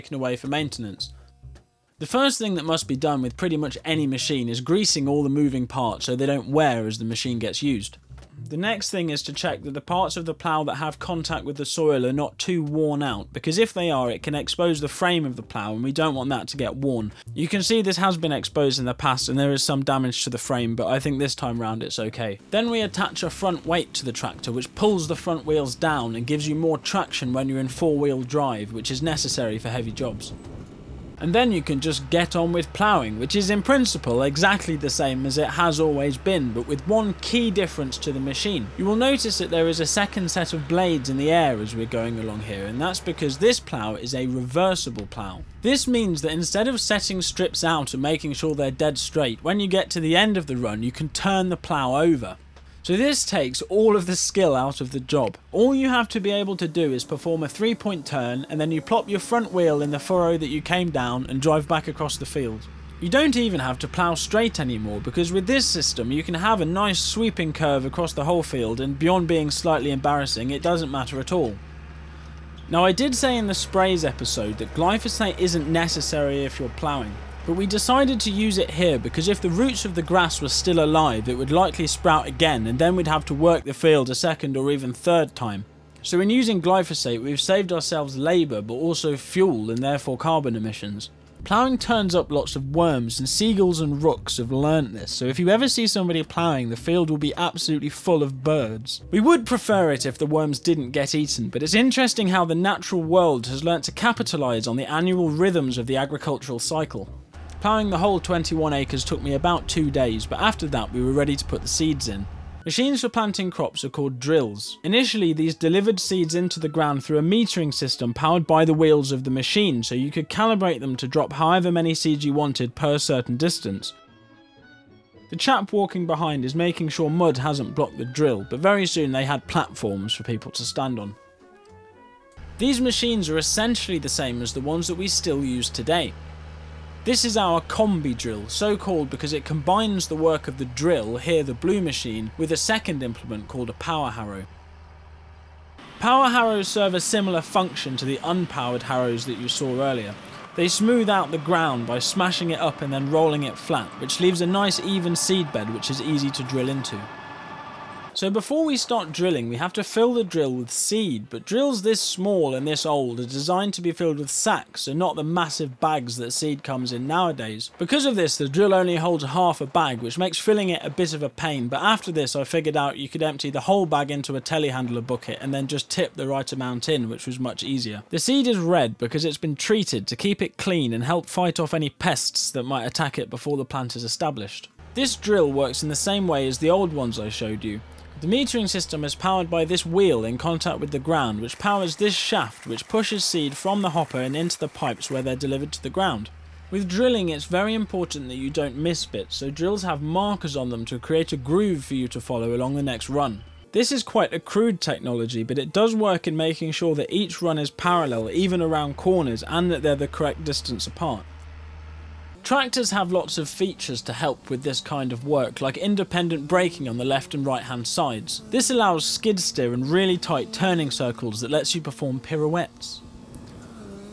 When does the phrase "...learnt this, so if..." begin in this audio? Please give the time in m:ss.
1:34.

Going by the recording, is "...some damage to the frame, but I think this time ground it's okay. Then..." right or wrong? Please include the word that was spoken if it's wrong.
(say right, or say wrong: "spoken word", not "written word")
wrong: "round", not "ground".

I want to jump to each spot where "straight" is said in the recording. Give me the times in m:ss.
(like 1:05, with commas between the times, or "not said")
0:48, 1:04.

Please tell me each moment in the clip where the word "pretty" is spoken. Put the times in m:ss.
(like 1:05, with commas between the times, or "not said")
0:03.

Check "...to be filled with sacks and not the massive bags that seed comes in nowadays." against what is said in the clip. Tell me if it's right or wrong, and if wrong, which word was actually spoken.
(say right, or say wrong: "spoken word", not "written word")
right.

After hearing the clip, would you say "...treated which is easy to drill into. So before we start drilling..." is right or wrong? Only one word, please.
wrong.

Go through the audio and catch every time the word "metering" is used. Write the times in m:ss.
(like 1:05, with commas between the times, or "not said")
1:57, 3:08.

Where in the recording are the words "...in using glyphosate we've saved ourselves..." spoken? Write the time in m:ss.
1:26.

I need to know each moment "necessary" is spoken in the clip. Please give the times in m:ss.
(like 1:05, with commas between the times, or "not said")
0:29, 1:15.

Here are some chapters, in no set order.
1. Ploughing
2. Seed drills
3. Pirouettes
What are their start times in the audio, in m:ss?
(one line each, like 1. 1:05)
1. 0:30
2. 1:51
3. 3:31.